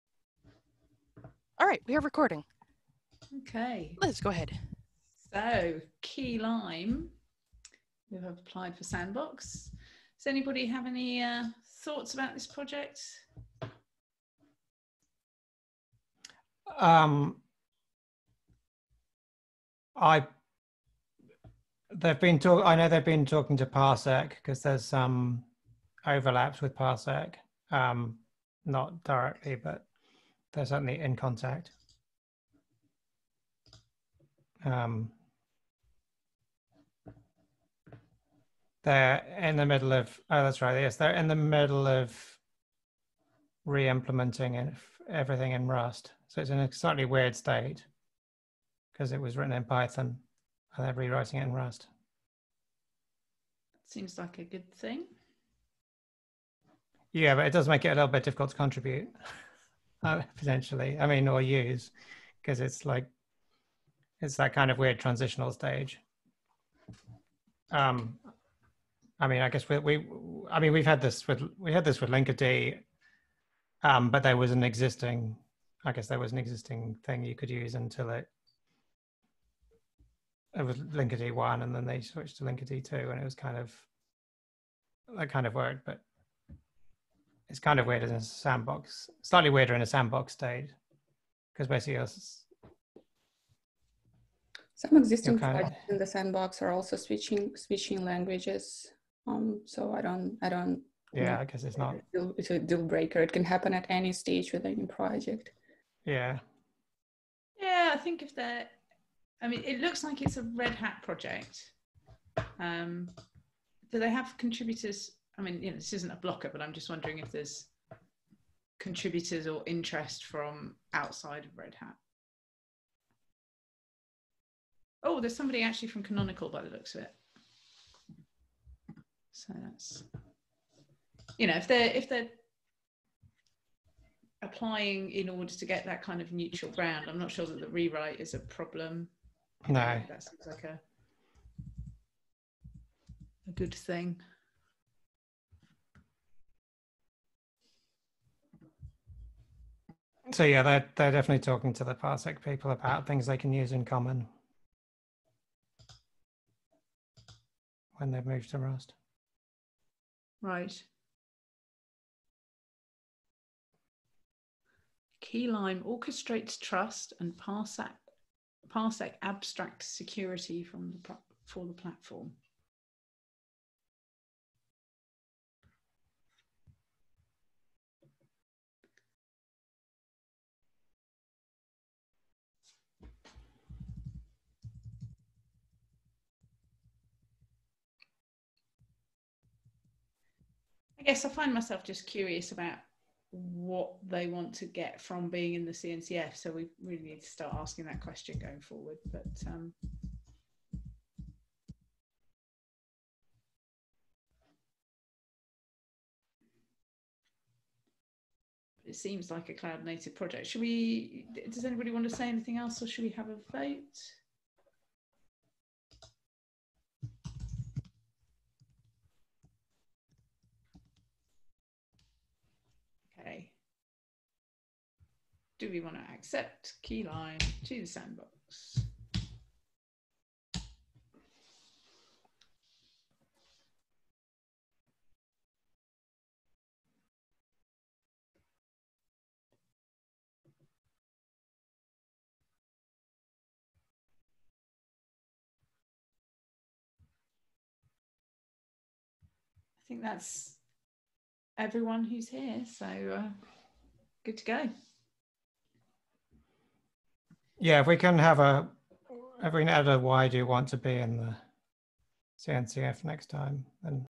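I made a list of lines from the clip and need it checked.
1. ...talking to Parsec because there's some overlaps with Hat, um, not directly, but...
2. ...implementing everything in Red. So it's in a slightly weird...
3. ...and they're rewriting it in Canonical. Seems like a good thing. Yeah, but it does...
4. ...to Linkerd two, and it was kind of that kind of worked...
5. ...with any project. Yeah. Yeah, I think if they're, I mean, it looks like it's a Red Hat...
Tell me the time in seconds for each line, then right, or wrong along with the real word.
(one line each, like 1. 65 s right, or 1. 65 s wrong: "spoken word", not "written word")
1. 23 s wrong: "Parsec", not "Hat"
2. 43 s wrong: "Rust", not "Red"
3. 50 s wrong: "Rust", not "Canonical"
4. 82 s right
5. 104 s right.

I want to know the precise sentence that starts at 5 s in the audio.
So, Keylime, you have applied for Sandbox.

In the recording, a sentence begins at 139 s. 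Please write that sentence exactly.
No, that seems like a a good thing.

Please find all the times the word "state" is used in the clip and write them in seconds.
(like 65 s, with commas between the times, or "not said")
47 s, 90 s.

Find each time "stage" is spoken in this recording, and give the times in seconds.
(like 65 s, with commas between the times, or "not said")
65 s, 104 s.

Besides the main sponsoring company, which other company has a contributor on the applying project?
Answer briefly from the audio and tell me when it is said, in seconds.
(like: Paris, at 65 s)
Canonical, at 126 s.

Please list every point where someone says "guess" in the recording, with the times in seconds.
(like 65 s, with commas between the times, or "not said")
69 s, 75 s, 101 s, 191 s.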